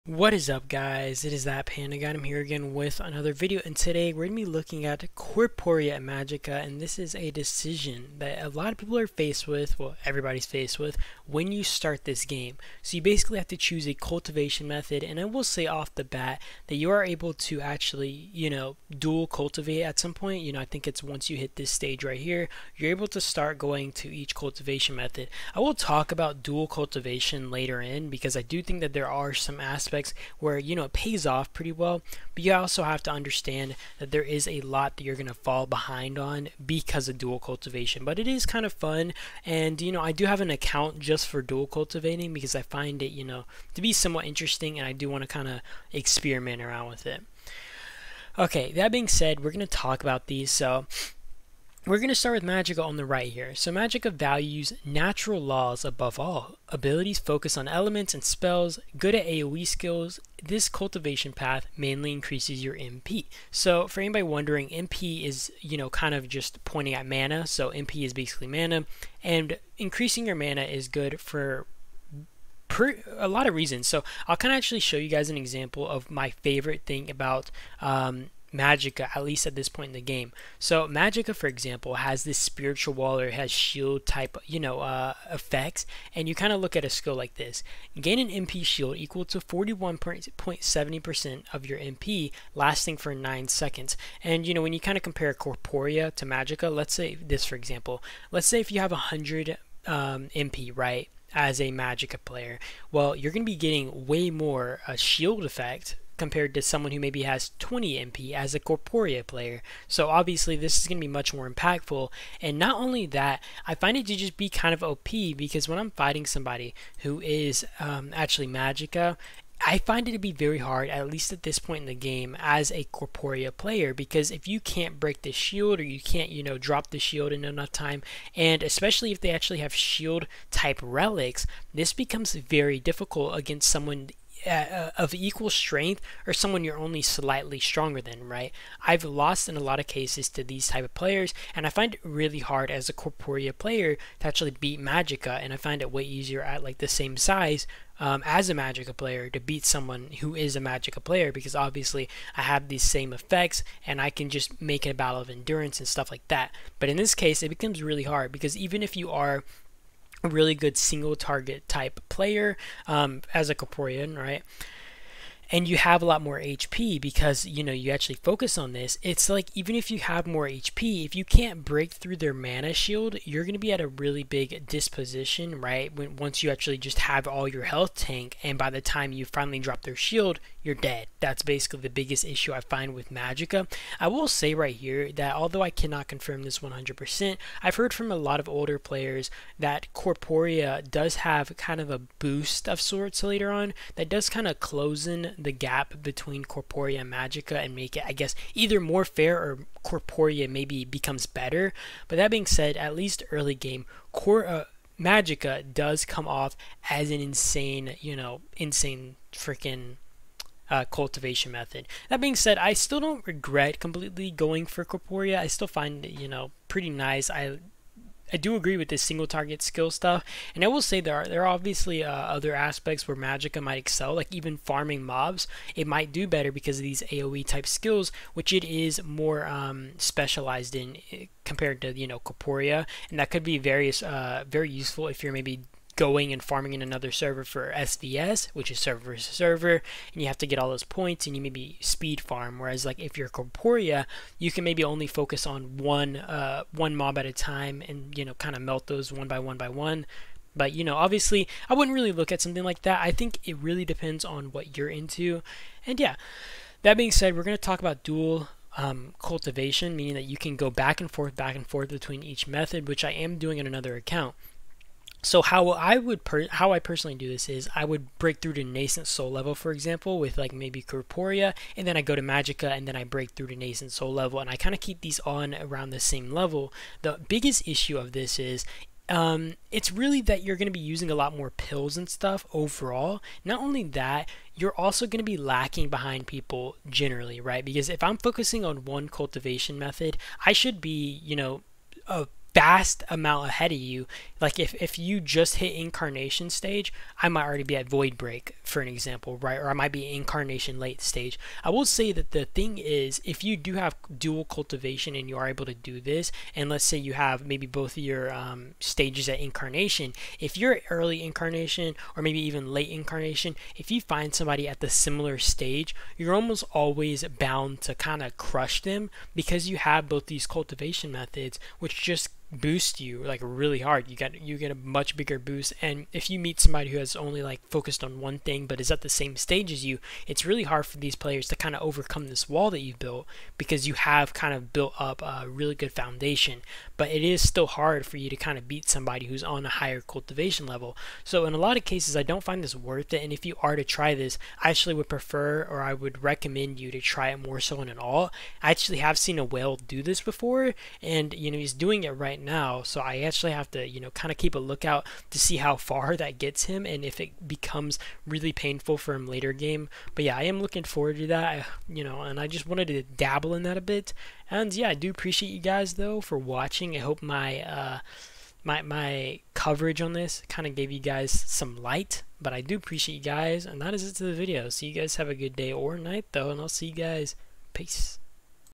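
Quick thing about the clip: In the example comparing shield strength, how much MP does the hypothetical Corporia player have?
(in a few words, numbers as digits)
20.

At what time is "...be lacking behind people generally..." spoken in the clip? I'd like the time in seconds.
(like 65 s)
285 s.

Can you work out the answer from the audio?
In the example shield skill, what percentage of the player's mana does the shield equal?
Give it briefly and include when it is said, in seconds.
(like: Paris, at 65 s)
41.70%, at 89 s.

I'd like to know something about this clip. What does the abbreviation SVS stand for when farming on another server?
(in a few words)
server versus server.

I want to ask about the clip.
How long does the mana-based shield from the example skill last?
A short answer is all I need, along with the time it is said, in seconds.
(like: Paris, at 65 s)
9 seconds, at 93 s.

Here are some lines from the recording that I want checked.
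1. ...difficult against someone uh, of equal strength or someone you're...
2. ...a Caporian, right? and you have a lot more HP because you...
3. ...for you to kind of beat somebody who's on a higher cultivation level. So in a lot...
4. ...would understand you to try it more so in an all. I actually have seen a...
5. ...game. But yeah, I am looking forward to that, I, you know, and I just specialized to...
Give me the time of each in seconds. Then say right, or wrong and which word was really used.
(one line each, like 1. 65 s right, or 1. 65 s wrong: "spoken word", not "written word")
1. 132 s right
2. 163 s right
3. 338 s right
4. 345 s wrong: "recommend", not "understand"
5. 359 s wrong: "wanted", not "specialized".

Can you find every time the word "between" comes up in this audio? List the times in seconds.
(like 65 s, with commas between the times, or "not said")
196 s, 261 s.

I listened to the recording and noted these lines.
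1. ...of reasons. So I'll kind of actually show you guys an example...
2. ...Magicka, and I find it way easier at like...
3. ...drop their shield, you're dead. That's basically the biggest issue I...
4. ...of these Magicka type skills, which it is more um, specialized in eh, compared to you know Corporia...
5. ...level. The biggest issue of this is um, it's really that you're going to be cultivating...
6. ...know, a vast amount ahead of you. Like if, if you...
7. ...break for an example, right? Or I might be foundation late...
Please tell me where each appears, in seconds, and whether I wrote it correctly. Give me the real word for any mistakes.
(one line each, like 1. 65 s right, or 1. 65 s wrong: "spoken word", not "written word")
1. 73 s right
2. 144 s right
3. 179 s right
4. 226 s wrong: "AOE", not "Magicka"
5. 276 s wrong: "using", not "cultivating"
6. 291 s right
7. 298 s wrong: "incarnation", not "foundation".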